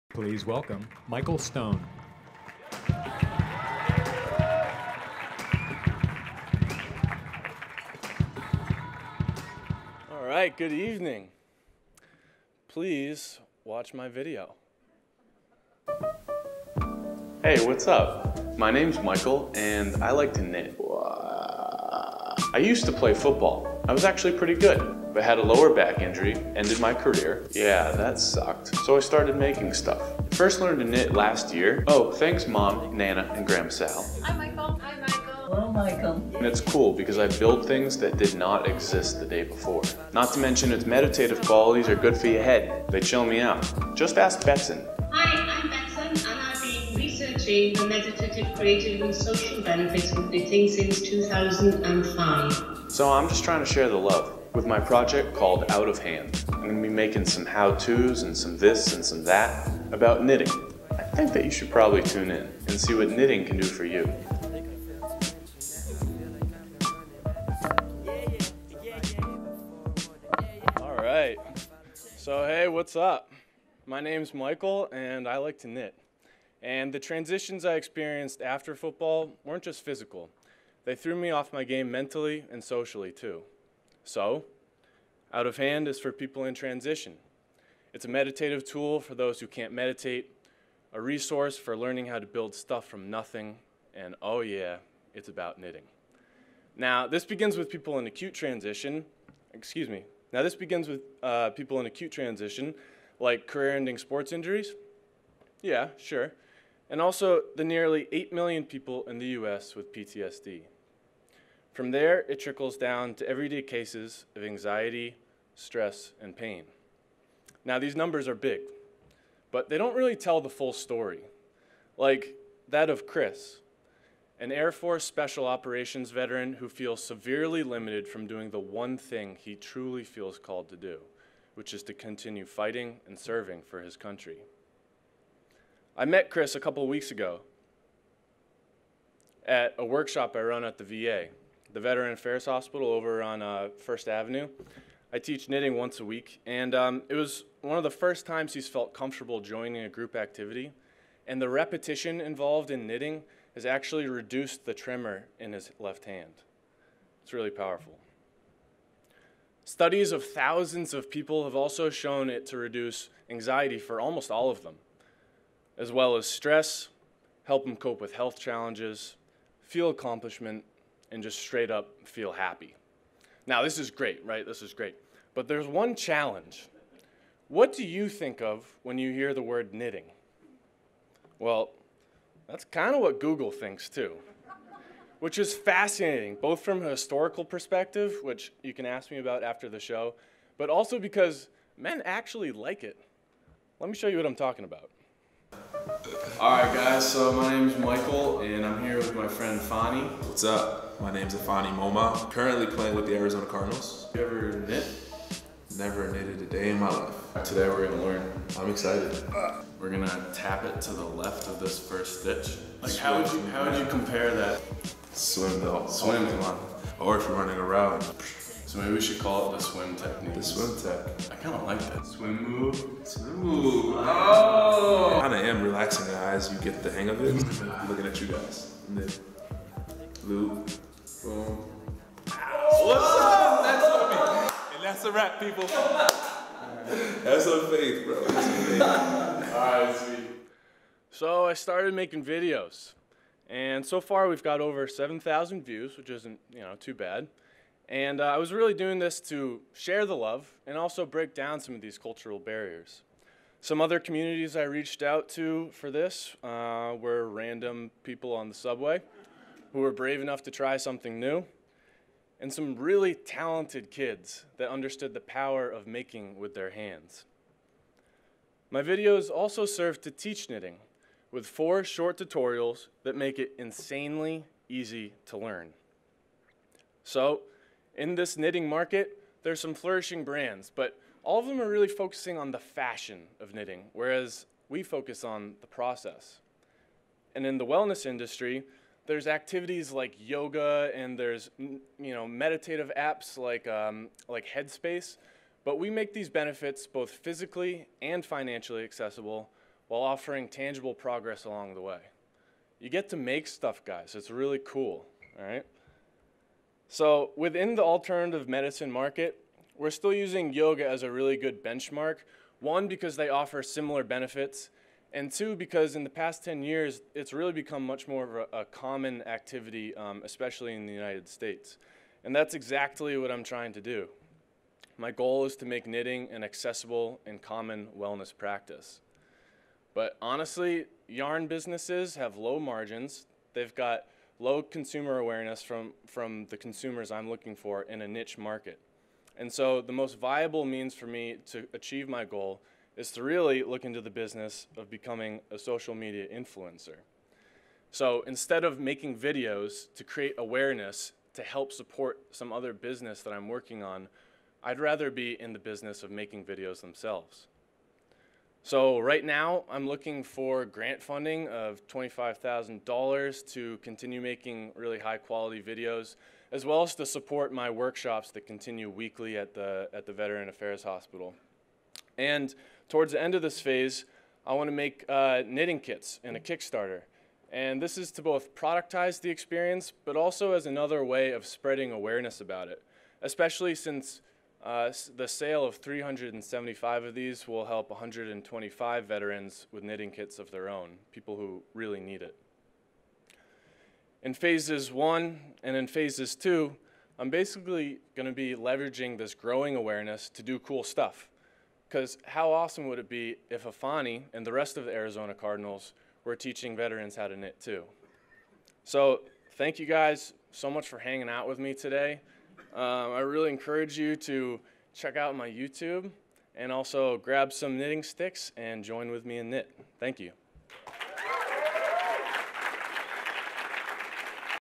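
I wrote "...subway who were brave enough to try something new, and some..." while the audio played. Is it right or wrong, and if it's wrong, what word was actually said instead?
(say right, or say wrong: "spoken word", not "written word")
right.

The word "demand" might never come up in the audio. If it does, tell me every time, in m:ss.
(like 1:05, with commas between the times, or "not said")
not said.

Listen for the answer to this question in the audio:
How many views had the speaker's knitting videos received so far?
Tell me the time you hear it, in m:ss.
4:04.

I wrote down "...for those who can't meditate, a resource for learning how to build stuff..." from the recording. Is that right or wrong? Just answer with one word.
right.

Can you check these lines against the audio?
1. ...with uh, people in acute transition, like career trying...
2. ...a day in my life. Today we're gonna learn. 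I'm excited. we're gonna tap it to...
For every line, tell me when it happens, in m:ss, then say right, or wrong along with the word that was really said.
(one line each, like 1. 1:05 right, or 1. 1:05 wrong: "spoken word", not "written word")
1. 1:40 wrong: "ending", not "trying"
2. 3:26 right.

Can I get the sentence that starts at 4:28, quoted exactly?
My videos also serve to teach knitting with four short tutorials that make it insanely easy to learn.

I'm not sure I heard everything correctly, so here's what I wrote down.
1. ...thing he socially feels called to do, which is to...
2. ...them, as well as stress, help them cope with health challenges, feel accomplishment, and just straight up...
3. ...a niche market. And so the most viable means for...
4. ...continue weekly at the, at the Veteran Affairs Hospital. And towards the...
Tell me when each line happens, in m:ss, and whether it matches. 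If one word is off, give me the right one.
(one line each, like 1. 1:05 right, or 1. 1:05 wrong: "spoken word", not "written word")
1. 2:08 wrong: "truly", not "socially"
2. 2:44 right
3. 5:38 right
4. 6:08 right.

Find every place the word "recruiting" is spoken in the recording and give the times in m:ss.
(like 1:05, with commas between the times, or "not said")
not said.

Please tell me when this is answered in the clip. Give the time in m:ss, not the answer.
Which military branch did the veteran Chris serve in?
2:04.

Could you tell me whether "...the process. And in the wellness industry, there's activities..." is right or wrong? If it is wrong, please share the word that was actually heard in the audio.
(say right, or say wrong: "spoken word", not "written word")
right.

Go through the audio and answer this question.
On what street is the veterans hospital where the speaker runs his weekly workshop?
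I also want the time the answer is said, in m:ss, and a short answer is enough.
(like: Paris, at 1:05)
First Avenue, at 2:23.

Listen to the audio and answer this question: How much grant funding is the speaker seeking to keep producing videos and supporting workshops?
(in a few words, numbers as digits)
$25,000.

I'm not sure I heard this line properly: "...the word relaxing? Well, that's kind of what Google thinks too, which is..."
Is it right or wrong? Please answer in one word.
wrong.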